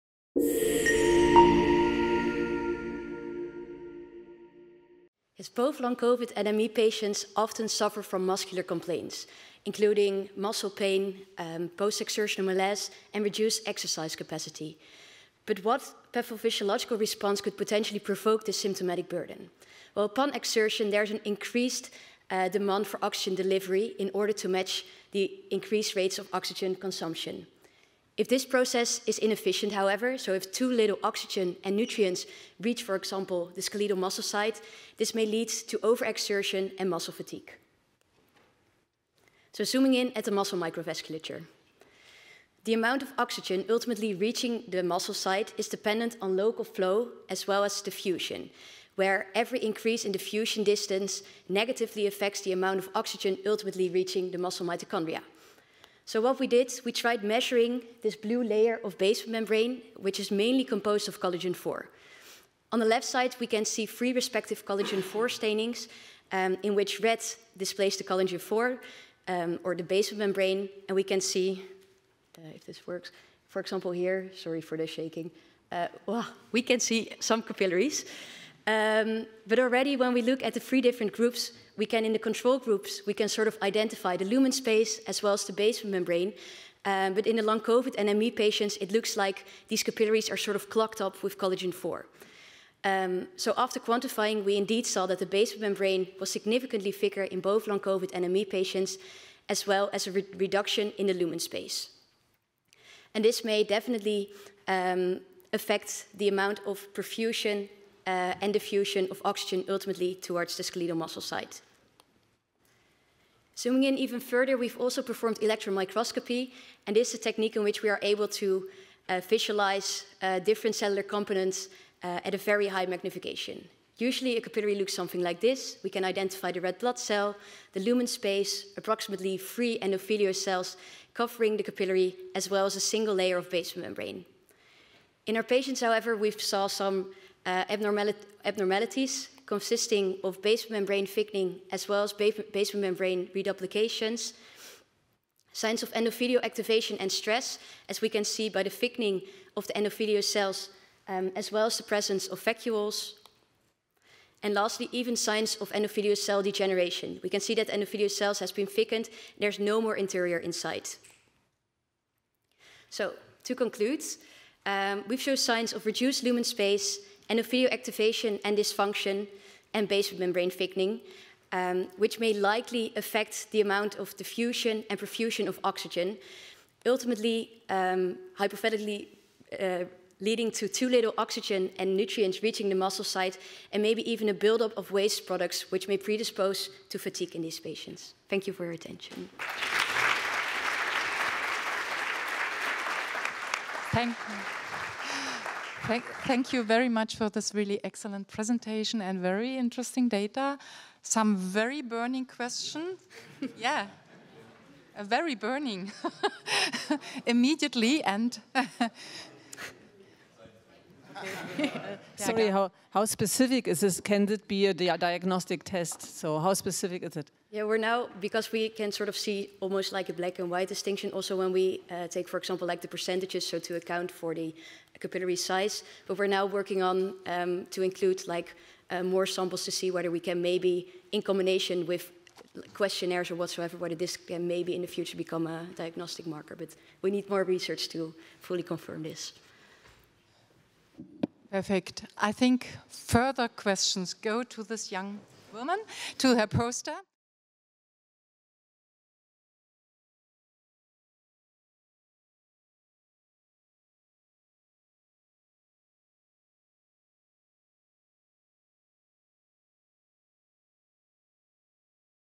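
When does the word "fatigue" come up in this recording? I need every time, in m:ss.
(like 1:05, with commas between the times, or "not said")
0:37, 3:06.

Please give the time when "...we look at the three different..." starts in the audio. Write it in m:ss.
1:20.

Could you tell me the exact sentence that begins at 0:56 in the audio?
So what we did, we tried measuring this blue layer of basement membrane, which is mainly composed of collagen 4.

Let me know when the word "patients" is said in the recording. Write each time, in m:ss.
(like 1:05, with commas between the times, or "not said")
0:06, 1:28, 1:38, 2:15, 3:07.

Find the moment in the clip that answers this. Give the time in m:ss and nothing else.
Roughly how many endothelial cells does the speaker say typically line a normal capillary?
2:09.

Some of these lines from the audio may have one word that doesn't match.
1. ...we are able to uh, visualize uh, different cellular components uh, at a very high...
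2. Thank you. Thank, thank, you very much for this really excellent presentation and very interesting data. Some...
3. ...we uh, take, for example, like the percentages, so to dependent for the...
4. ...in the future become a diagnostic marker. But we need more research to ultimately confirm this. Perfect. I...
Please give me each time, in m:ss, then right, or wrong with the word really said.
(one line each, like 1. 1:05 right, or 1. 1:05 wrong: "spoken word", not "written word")
1. 1:57 right
2. 3:13 right
3. 3:41 wrong: "account", not "dependent"
4. 3:54 wrong: "fully", not "ultimately".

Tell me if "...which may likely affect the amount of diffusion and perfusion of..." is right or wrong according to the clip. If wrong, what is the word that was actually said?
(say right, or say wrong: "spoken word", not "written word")
right.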